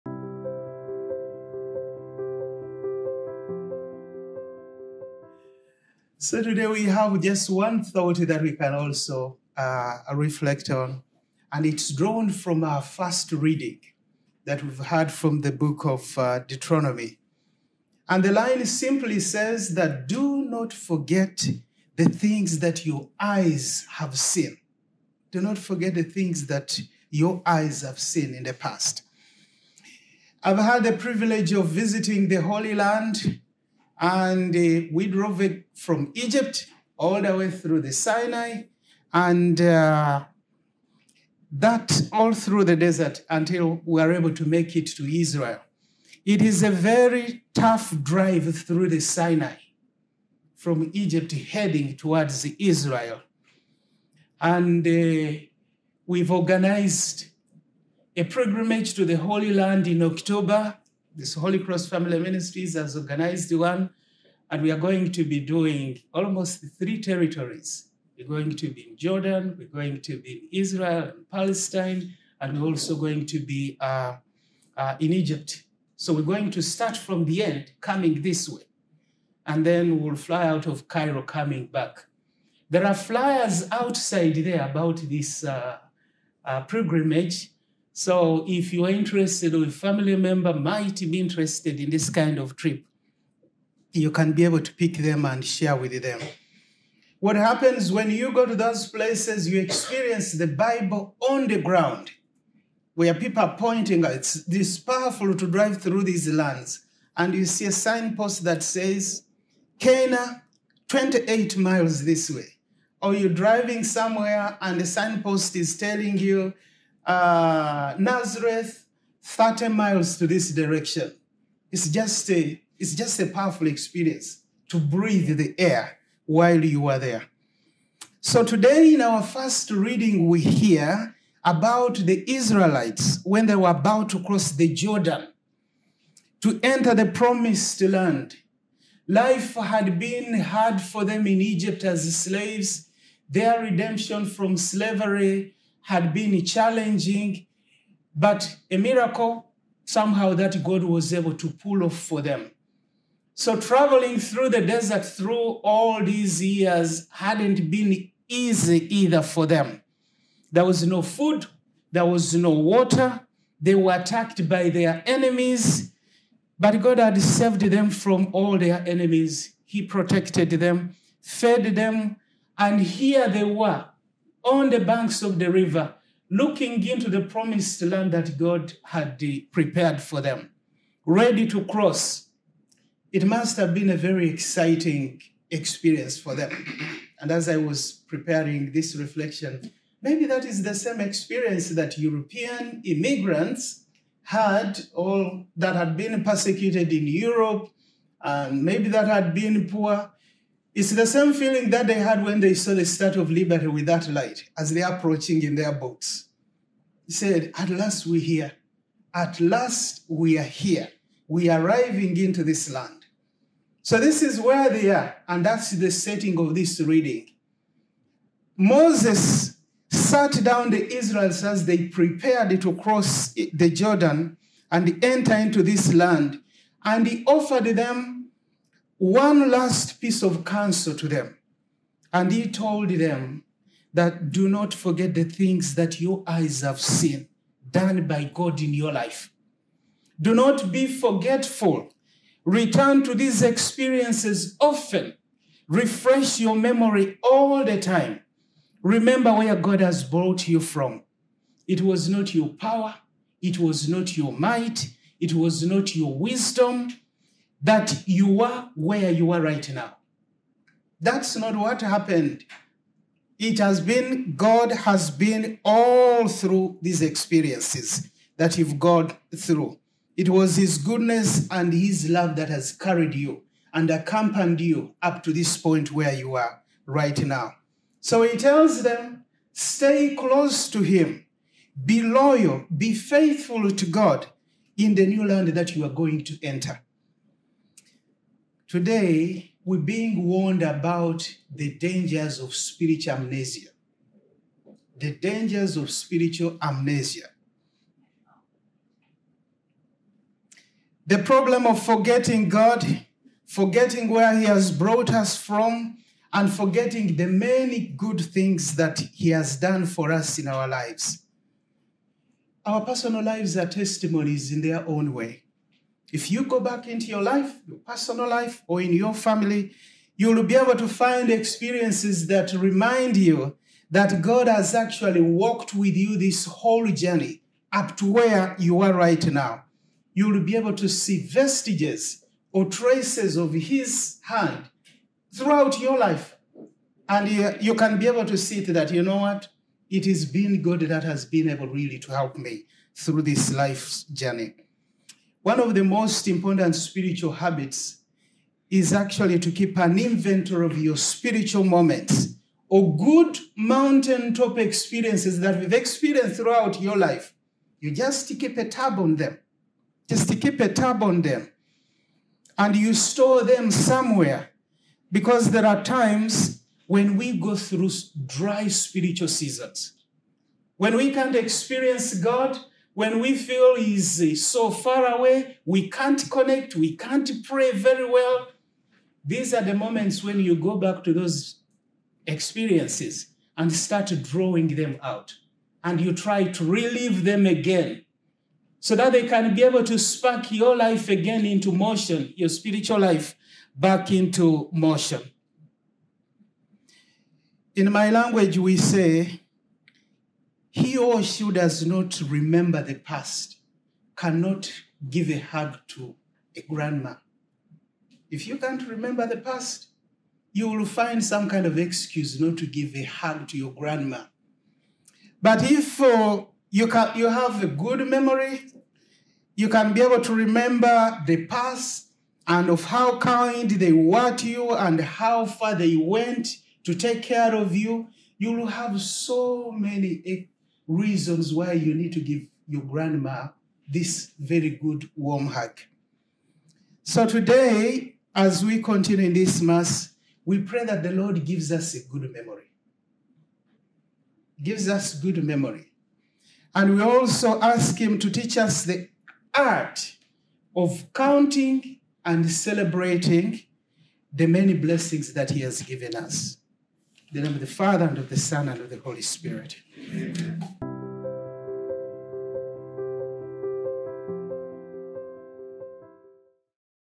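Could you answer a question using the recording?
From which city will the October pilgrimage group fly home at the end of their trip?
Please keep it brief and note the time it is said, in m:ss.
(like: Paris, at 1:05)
Cairo, at 1:20.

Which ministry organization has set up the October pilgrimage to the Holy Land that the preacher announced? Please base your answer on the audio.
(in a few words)
Holy Cross Family Ministries.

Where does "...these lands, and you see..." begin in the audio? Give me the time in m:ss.
1:46.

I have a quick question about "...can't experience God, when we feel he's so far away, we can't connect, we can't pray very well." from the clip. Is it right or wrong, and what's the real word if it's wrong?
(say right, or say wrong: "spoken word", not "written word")
right.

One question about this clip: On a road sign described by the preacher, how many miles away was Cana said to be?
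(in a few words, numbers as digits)
28 miles.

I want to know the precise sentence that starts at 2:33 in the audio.
So traveling through the desert through all these years hadn't been easy either for them.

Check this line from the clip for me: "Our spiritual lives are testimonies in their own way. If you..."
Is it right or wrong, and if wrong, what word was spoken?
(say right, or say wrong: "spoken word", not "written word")
wrong: "personal", not "spiritual".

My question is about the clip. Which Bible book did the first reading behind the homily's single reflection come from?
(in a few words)
Deuteronomy.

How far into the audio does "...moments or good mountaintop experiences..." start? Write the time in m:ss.
5:51.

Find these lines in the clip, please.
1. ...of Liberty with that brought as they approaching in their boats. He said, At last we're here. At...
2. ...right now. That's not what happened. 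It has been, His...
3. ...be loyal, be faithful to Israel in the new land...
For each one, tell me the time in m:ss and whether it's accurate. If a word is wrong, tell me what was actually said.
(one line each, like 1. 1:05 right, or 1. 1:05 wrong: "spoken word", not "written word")
1. 3:23 wrong: "light", not "brought"
2. 4:19 wrong: "God", not "His"
3. 4:41 wrong: "God", not "Israel".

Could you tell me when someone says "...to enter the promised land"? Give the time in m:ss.
2:16.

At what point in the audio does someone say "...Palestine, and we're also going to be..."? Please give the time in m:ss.
1:11.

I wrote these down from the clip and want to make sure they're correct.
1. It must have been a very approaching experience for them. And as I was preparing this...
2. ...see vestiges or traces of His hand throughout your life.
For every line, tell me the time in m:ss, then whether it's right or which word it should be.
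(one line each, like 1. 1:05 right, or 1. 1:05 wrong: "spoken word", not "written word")
1. 3:03 wrong: "exciting", not "approaching"
2. 5:30 right.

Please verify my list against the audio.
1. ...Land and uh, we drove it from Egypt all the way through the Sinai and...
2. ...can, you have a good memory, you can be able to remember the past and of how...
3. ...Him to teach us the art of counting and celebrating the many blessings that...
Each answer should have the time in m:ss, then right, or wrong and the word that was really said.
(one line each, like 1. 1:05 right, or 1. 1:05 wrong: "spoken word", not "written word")
1. 0:32 right
2. 6:56 right
3. 7:27 right.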